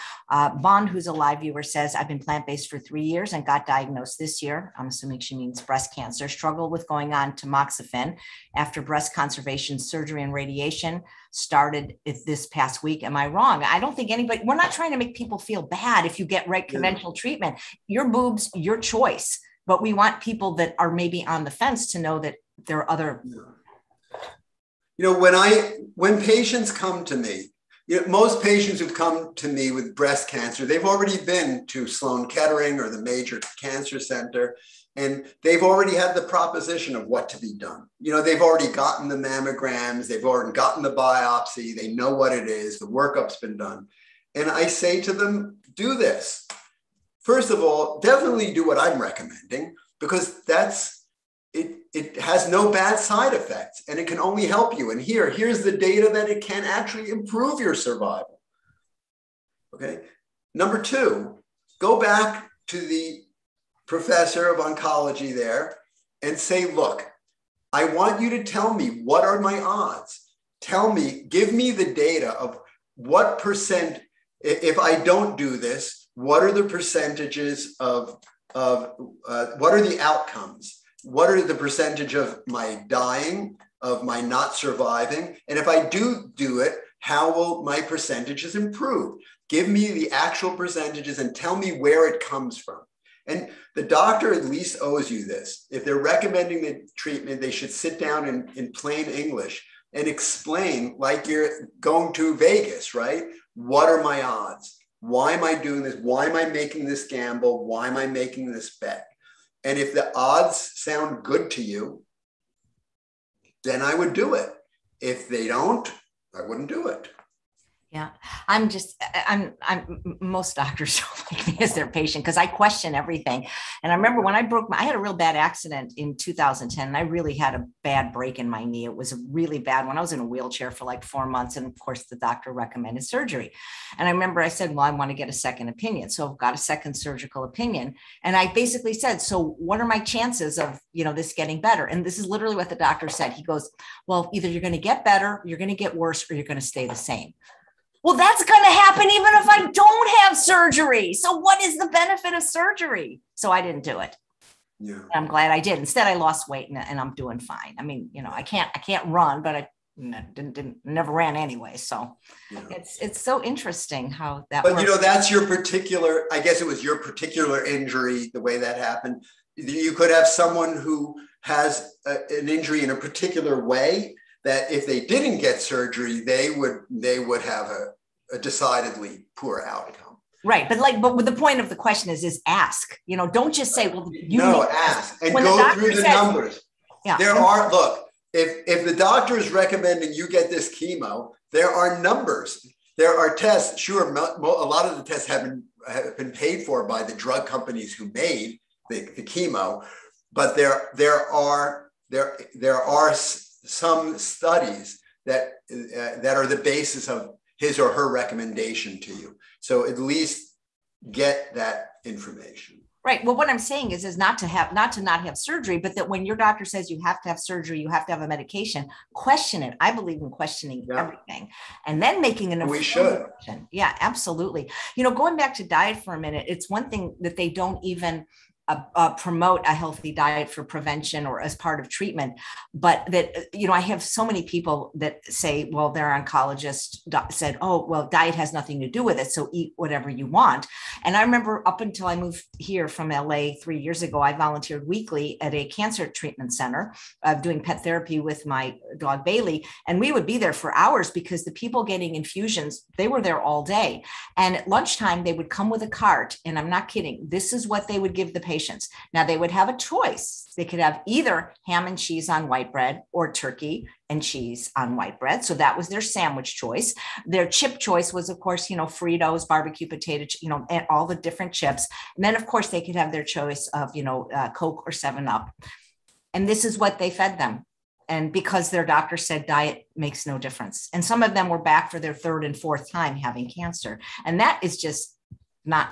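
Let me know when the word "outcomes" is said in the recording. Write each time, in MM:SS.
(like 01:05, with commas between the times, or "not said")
01:20, 02:59.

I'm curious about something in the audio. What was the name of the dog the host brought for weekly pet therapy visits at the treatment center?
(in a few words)
Bailey.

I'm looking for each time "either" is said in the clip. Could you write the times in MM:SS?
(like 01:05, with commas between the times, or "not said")
02:24, 04:21.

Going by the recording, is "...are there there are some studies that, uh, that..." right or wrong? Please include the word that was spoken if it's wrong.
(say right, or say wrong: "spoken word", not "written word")
right.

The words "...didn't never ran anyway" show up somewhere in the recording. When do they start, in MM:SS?
02:40.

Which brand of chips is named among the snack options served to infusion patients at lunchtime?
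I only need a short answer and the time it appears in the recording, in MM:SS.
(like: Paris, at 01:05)
Fritos, at 04:28.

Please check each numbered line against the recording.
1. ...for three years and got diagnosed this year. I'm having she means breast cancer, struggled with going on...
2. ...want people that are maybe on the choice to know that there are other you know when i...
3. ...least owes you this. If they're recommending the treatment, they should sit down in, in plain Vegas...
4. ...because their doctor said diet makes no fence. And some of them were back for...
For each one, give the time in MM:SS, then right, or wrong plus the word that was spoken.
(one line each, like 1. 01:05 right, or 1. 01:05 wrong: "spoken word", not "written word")
1. 00:02 wrong: "assuming", not "having"
2. 00:19 wrong: "fence", not "choice"
3. 01:34 wrong: "English", not "Vegas"
4. 04:38 wrong: "difference", not "fence".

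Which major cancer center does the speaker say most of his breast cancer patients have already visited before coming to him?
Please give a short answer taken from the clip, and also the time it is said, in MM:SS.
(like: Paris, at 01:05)
Sloan Kettering, at 00:31.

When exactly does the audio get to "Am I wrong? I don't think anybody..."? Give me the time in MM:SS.
00:13.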